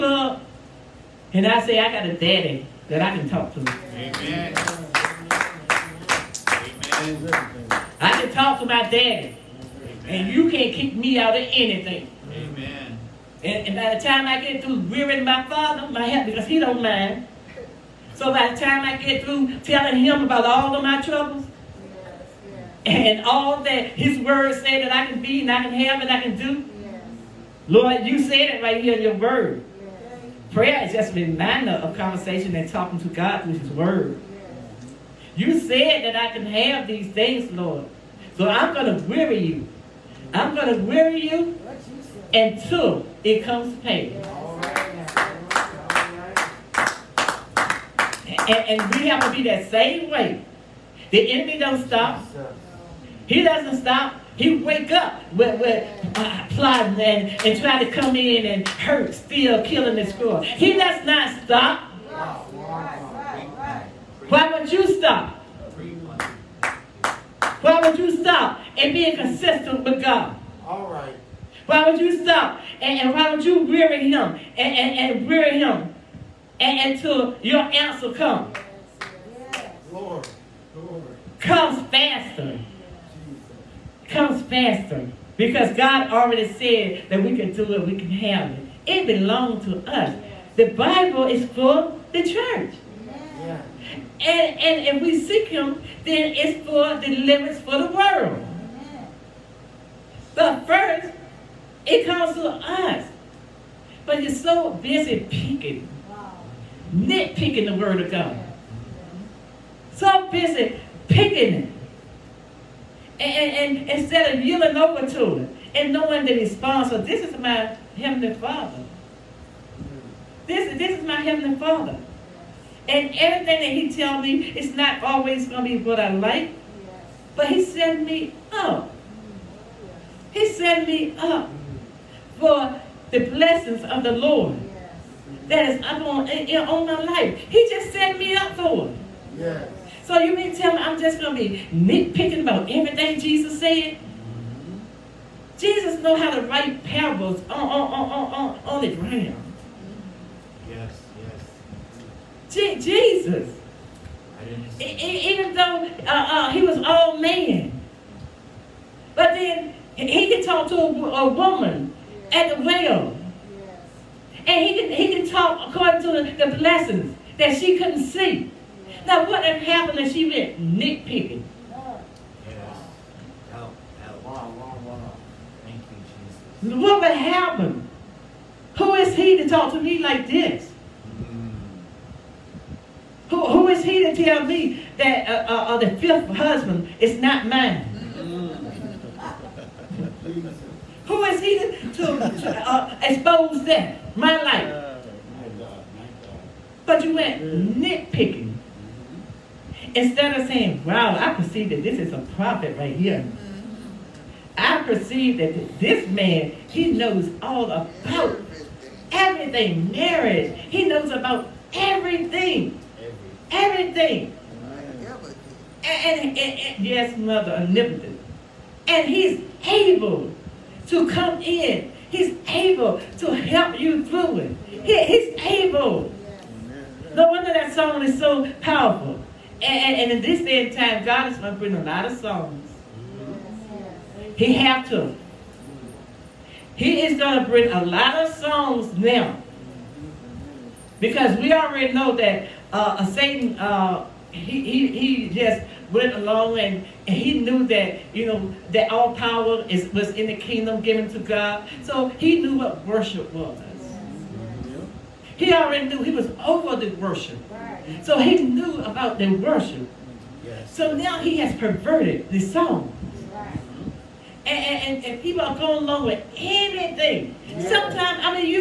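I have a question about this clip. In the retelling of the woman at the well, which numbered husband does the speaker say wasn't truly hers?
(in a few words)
fifth.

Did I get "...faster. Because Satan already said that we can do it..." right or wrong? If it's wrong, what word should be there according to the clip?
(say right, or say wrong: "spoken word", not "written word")
wrong: "God", not "Satan".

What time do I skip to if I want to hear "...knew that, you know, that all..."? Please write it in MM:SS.
04:07.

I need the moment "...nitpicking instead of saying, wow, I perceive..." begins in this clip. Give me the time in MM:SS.
03:17.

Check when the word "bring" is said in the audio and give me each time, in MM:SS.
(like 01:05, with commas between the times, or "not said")
03:51, 03:57.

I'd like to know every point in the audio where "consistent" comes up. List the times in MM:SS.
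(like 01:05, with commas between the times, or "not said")
01:09.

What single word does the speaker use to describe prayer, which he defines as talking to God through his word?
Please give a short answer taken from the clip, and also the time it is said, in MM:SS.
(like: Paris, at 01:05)
reminder, at 00:31.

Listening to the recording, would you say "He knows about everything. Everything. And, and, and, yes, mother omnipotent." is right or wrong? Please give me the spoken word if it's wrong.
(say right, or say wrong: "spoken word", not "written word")
right.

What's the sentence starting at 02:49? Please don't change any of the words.
Now, what have happened if she went nitpicking?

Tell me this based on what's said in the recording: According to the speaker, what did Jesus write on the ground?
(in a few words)
parables.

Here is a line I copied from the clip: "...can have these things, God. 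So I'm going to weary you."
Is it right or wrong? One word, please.
wrong.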